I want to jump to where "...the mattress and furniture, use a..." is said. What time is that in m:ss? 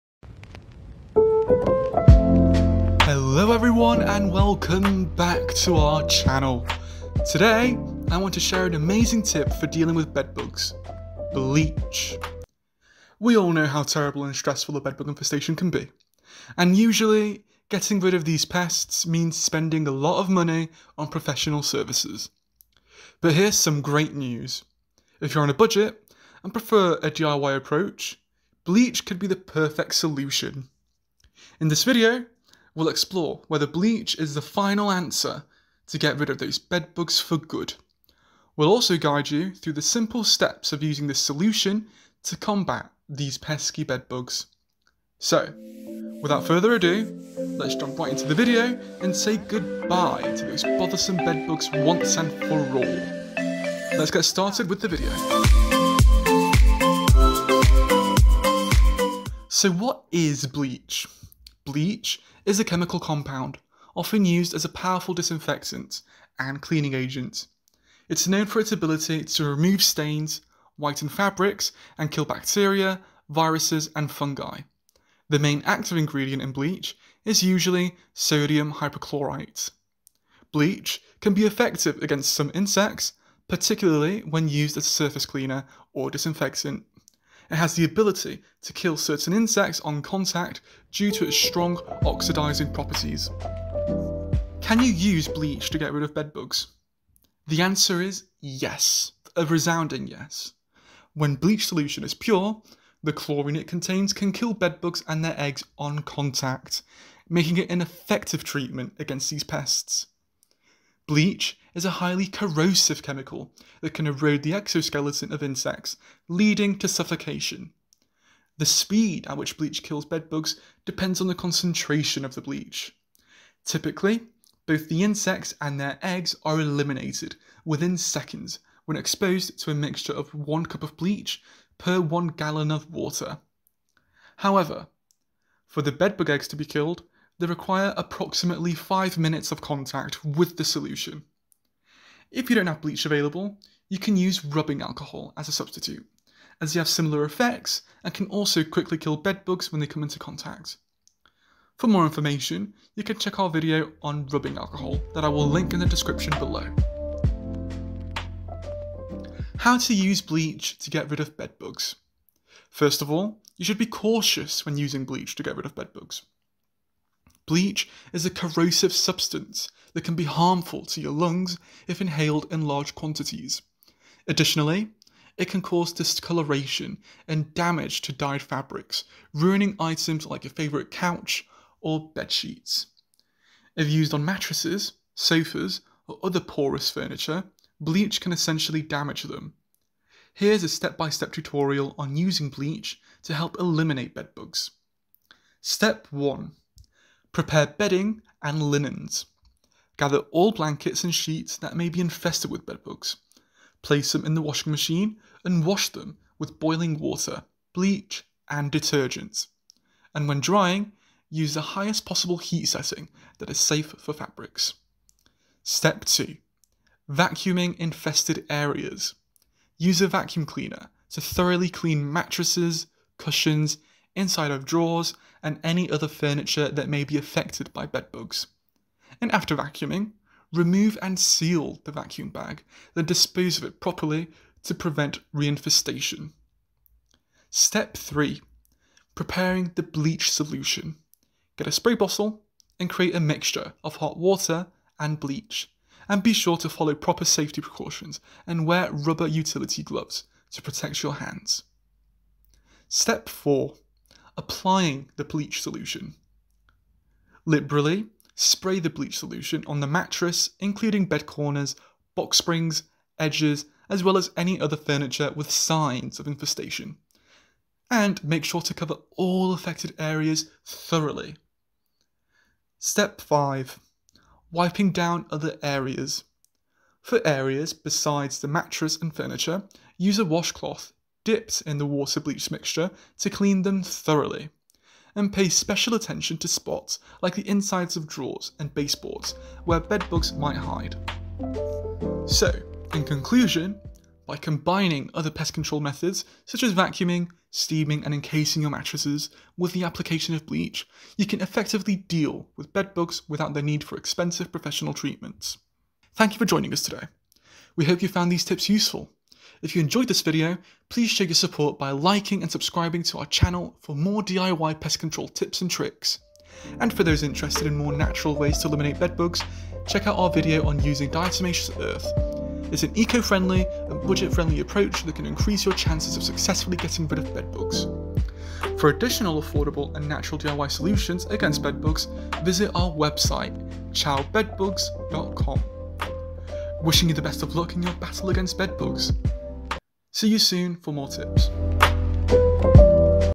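4:38.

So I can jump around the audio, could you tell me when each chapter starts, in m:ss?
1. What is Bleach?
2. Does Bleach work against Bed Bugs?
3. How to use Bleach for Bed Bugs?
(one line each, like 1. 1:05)
1. 0:59
2. 1:34
3. 2:39.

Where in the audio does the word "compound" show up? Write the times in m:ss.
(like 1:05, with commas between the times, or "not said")
1:02.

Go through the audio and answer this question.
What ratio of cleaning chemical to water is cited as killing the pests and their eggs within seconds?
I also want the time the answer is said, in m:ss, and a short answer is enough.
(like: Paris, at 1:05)
1 cup per 1 gallon, at 2:10.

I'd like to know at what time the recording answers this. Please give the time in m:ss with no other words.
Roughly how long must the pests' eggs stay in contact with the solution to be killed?
2:18.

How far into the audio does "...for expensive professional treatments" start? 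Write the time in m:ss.
5:03.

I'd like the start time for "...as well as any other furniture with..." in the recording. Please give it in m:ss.
4:23.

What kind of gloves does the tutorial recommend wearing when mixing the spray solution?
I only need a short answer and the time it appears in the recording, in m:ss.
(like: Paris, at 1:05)
rubber utility gloves, at 4:08.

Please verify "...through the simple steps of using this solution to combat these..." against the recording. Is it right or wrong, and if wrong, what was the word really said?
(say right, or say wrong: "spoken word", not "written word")
right.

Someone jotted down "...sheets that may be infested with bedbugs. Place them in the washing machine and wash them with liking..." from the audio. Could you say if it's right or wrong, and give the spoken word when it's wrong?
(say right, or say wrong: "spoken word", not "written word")
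wrong: "boiling", not "liking".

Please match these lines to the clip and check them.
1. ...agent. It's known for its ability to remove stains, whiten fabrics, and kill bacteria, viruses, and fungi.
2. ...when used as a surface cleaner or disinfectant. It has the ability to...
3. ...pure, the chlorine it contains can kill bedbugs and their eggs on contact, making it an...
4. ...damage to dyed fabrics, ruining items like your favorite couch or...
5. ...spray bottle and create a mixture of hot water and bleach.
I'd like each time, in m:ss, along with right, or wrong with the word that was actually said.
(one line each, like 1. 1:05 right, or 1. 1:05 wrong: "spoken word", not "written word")
1. 1:06 right
2. 1:24 right
3. 1:42 right
4. 2:57 right
5. 4:01 right.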